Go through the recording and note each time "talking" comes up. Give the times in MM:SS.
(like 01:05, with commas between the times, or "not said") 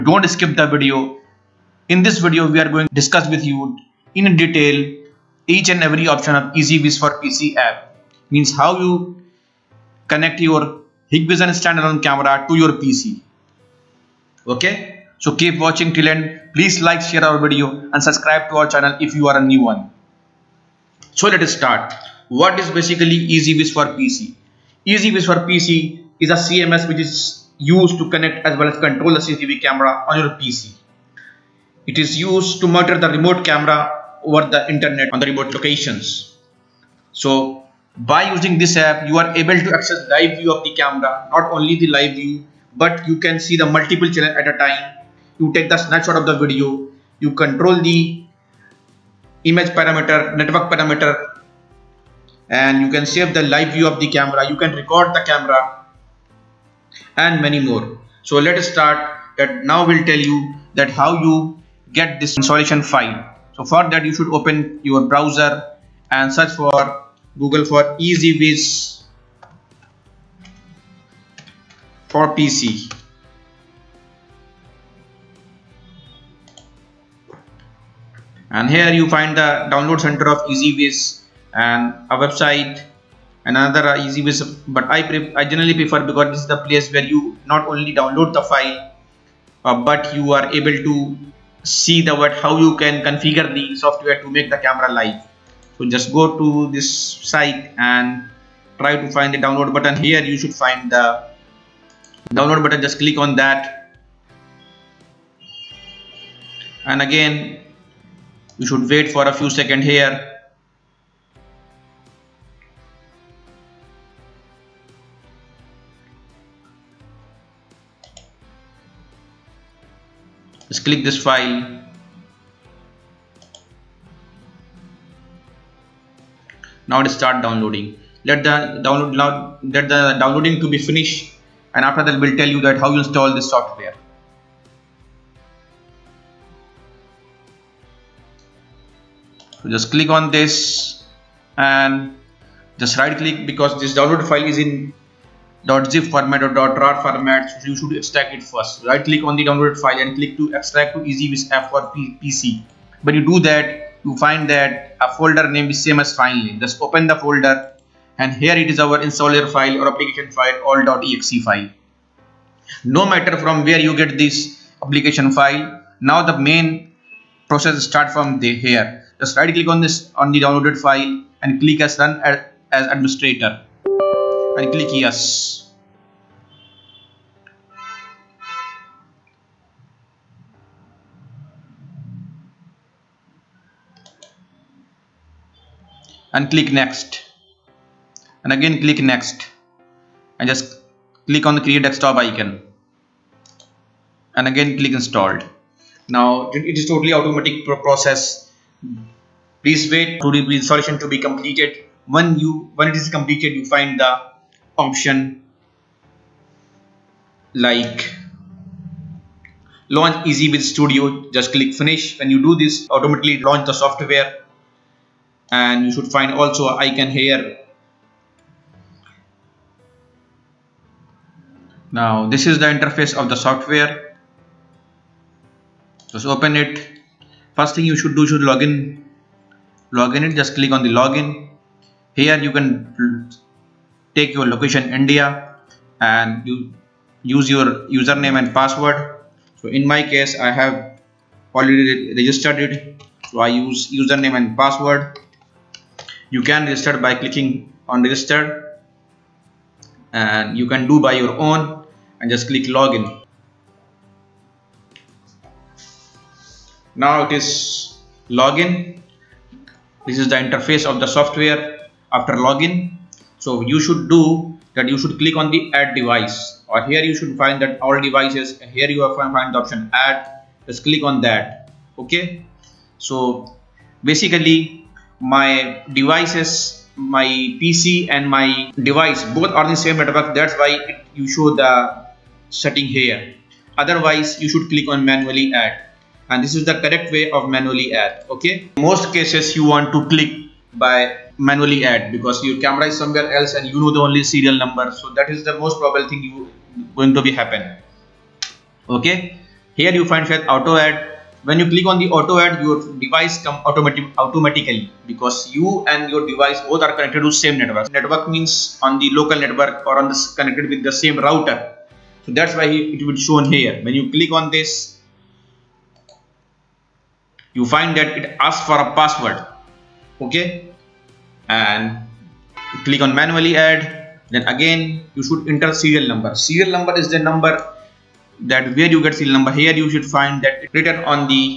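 not said.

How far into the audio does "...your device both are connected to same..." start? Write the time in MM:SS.
05:06.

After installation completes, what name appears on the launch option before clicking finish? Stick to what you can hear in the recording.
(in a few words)
EZVIZ studio.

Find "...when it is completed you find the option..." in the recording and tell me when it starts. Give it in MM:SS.
03:22.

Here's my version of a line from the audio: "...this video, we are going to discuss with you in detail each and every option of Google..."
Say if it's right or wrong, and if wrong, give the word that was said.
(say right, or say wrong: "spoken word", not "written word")
wrong: "EZVIZ", not "Google".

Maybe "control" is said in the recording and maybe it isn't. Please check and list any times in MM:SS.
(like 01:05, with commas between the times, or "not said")
00:28, 00:47.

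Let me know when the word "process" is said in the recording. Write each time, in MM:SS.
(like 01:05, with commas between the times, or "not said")
02:47, 03:17.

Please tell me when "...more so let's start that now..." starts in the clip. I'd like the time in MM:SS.
00:57.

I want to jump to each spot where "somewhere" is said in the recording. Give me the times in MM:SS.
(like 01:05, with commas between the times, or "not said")
04:52.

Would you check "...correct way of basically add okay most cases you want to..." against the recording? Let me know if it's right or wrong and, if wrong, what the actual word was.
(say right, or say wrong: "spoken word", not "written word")
wrong: "manually", not "basically".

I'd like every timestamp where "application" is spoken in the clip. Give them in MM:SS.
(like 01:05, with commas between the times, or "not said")
02:39, 02:44.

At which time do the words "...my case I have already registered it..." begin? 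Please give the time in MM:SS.
03:59.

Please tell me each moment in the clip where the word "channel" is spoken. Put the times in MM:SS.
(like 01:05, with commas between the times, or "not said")
00:18, 00:44.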